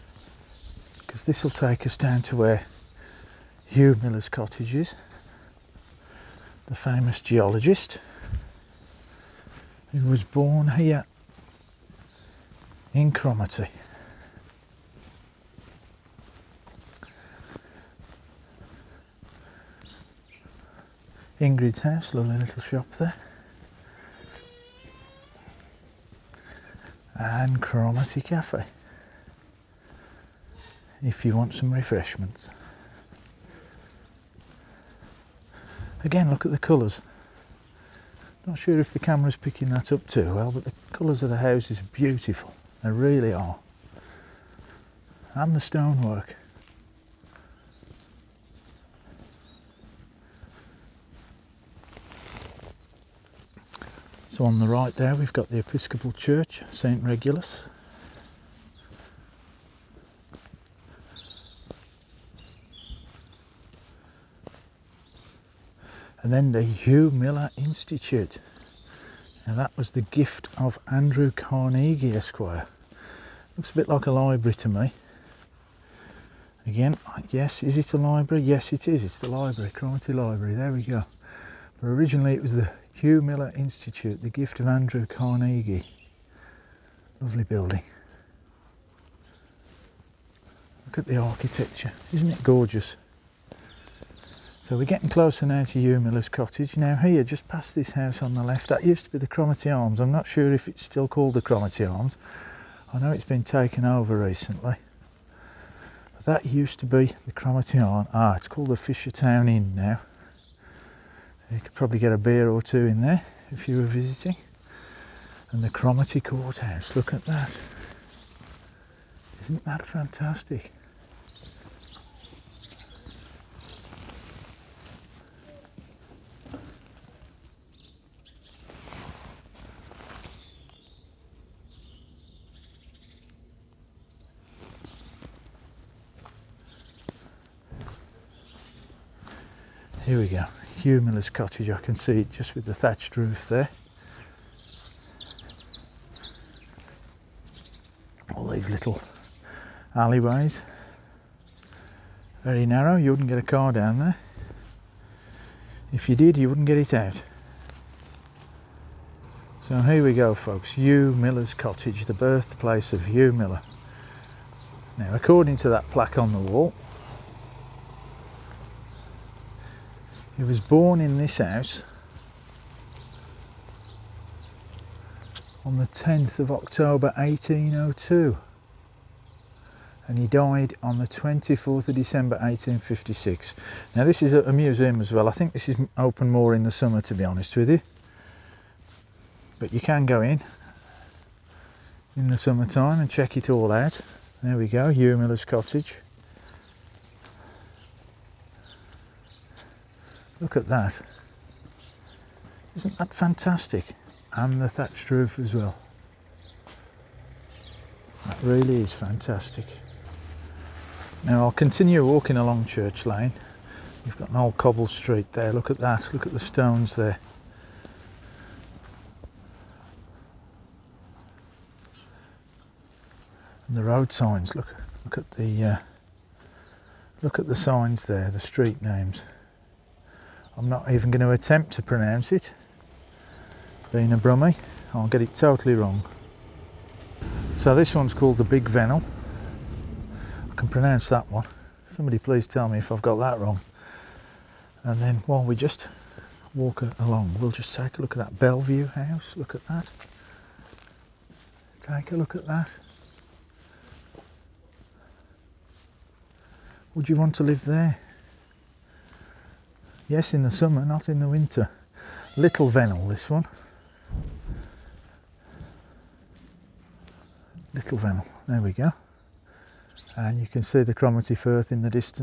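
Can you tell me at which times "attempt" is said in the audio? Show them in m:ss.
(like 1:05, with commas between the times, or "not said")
3:51.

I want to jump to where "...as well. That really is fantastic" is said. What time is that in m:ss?
3:25.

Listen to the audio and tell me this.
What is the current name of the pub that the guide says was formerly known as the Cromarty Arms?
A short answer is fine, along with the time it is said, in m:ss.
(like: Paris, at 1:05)
Fisher Town Inn, at 1:48.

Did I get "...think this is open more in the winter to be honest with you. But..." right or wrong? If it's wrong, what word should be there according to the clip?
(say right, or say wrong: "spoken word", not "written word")
wrong: "summer", not "winter".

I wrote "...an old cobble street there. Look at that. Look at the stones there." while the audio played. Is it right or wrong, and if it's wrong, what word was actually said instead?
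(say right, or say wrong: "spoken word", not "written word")
right.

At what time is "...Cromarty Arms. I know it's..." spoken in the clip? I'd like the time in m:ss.
1:41.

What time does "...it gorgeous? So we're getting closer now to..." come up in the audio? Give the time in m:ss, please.
1:32.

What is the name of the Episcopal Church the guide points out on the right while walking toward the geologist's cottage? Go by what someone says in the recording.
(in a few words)
St Regulus.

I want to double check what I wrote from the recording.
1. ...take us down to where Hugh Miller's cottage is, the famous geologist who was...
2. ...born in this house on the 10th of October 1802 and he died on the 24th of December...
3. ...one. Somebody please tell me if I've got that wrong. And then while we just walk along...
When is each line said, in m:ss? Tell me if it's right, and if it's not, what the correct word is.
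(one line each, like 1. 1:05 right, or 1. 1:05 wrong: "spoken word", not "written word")
1. 0:01 right
2. 2:50 right
3. 4:01 right.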